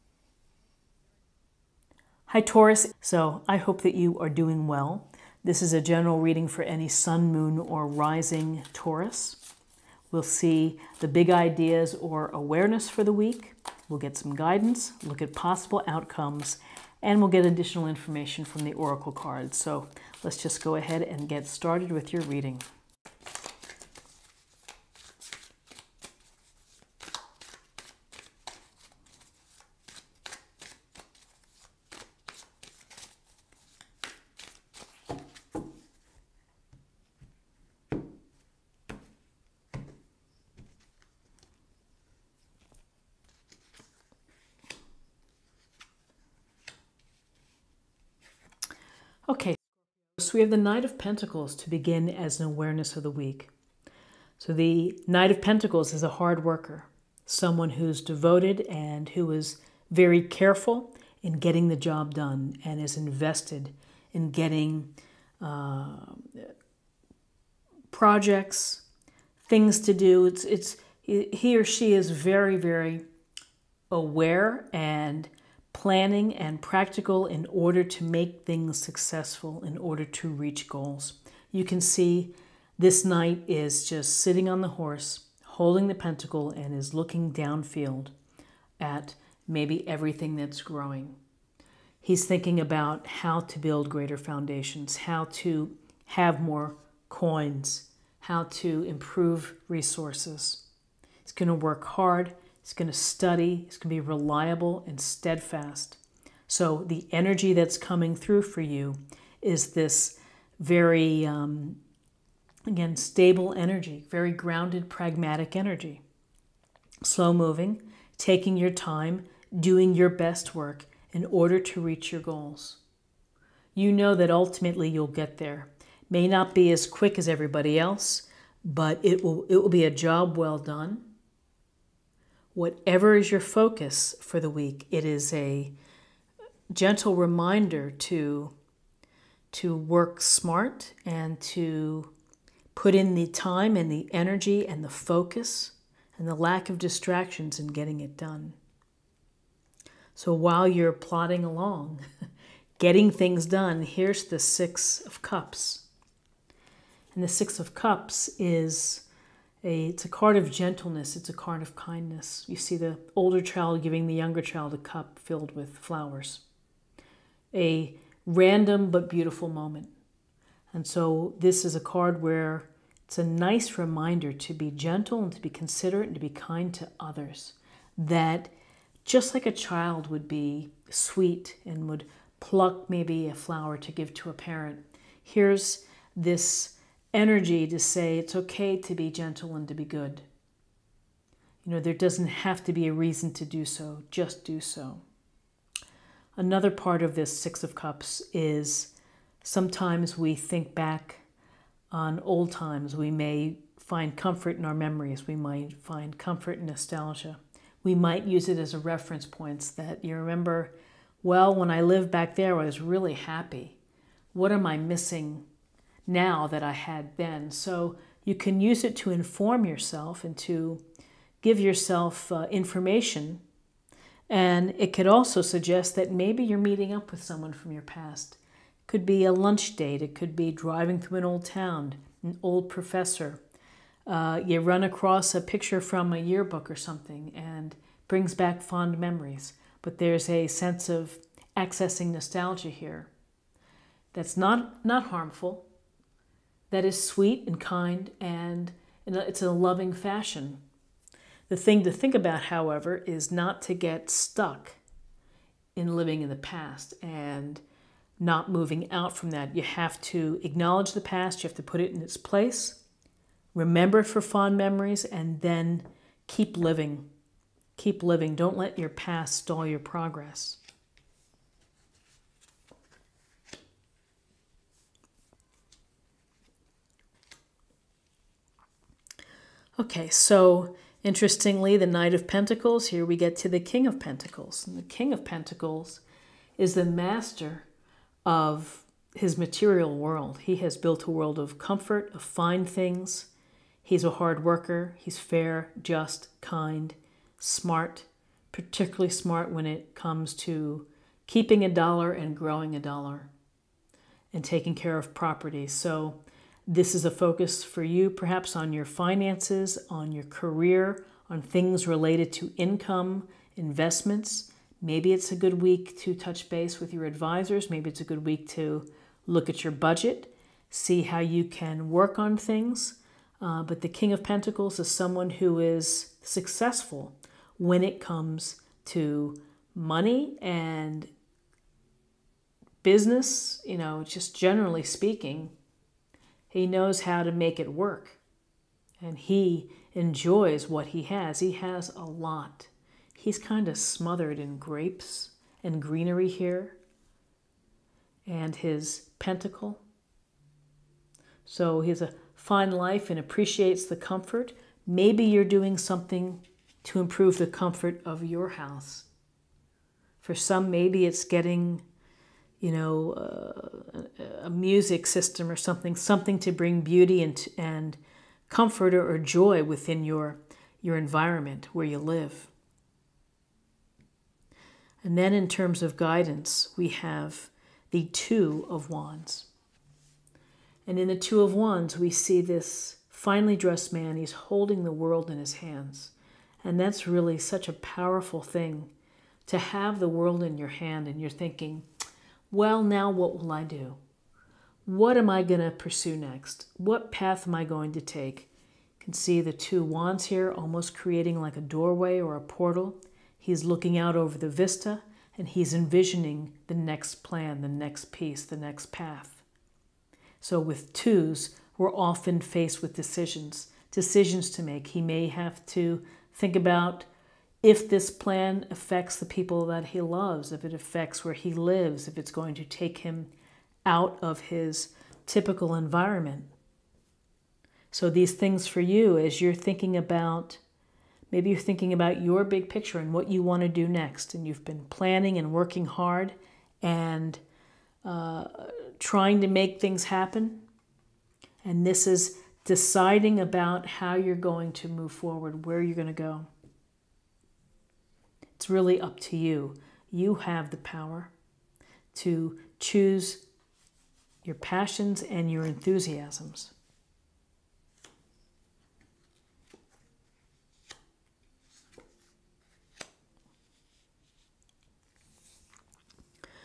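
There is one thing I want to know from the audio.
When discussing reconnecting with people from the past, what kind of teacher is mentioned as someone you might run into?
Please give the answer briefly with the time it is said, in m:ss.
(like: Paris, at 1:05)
an old professor, at 3:52.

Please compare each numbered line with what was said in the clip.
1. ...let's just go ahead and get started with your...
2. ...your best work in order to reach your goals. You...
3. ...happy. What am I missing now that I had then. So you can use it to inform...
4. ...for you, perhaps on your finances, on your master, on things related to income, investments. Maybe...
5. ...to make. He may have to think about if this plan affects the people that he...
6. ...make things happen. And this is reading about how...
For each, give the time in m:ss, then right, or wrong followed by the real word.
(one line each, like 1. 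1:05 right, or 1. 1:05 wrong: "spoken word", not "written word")
1. 0:20 right
2. 1:59 right
3. 3:33 right
4. 5:07 wrong: "career", not "master"
5. 6:54 right
6. 7:19 wrong: "deciding", not "reading".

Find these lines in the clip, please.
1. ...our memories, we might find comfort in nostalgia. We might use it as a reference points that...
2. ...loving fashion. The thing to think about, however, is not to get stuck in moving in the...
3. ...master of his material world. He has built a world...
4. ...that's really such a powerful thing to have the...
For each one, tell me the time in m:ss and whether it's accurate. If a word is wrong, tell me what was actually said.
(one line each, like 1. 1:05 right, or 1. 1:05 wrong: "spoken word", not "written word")
1. 3:24 right
2. 4:09 wrong: "living", not "moving"
3. 4:46 right
4. 6:26 right.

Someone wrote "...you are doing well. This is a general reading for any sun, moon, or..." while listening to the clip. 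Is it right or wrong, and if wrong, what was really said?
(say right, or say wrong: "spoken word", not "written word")
right.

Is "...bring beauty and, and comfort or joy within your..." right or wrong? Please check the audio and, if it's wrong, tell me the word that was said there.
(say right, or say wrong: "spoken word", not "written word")
right.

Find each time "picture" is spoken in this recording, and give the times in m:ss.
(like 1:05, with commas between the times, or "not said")
3:55, 7:12.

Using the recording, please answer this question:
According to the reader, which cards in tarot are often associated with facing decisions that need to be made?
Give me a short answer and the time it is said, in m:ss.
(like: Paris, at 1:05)
twos, at 6:50.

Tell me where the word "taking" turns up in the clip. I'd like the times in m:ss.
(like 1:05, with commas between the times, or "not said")
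1:58, 5:04.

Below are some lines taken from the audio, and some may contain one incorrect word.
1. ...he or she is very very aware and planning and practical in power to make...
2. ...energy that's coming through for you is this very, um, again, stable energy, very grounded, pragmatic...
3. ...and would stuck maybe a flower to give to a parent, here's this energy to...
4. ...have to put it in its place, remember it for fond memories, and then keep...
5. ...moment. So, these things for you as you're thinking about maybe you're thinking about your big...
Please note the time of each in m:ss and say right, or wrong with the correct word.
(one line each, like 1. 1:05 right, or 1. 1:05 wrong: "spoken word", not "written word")
1. 1:11 wrong: "order", not "power"
2. 1:47 right
3. 3:01 wrong: "pluck", not "stuck"
4. 4:21 right
5. 7:05 wrong: "environment", not "moment".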